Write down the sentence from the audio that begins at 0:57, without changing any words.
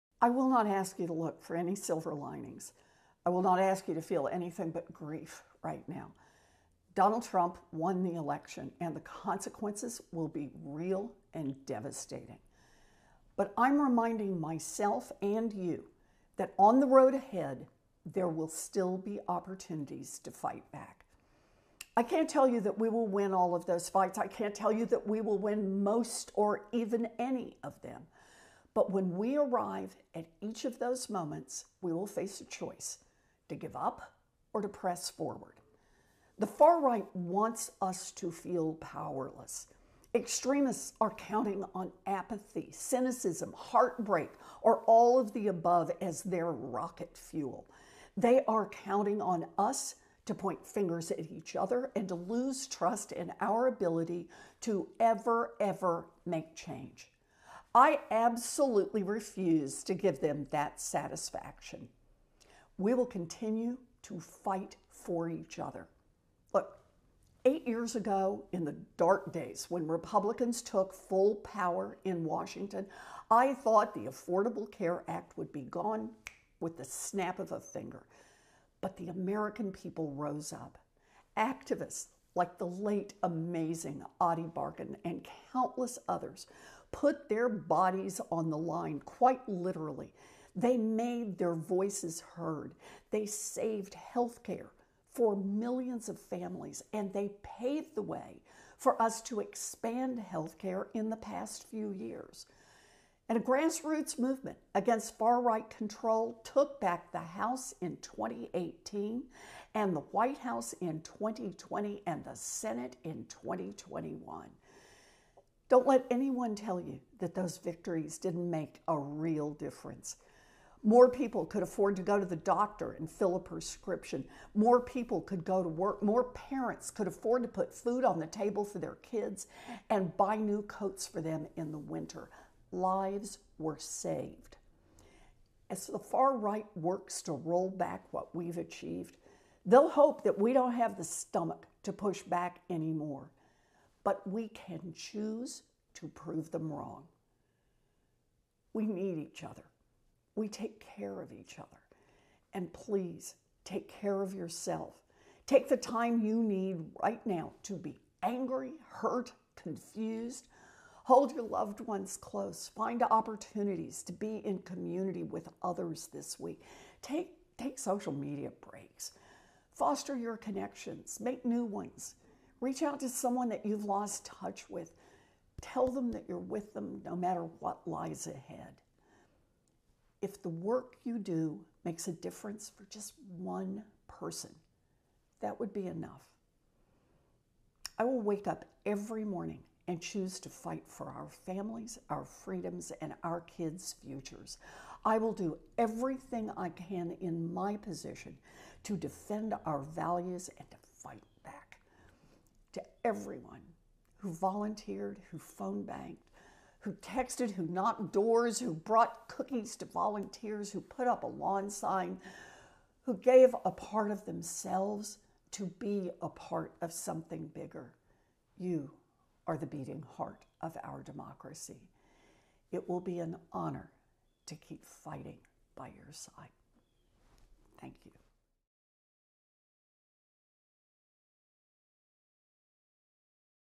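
I absolutely refuse to give them that satisfaction.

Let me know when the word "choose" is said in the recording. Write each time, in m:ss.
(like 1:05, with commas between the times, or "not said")
2:24, 3:10.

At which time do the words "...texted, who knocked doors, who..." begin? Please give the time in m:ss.
3:26.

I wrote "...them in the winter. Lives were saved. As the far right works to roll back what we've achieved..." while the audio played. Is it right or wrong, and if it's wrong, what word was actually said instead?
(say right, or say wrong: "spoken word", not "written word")
right.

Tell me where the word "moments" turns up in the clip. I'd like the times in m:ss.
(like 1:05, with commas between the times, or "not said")
0:31.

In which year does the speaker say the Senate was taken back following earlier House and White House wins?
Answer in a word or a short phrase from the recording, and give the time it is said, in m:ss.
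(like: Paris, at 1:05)
2021, at 1:53.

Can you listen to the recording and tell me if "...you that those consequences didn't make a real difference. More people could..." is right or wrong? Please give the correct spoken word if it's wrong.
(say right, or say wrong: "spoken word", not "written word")
wrong: "victories", not "consequences".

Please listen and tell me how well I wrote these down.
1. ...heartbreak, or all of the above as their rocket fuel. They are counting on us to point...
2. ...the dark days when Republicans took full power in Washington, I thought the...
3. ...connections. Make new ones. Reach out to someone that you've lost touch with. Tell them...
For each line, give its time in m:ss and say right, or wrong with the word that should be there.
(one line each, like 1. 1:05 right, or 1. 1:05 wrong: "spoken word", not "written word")
1. 0:43 right
2. 1:08 right
3. 2:50 right.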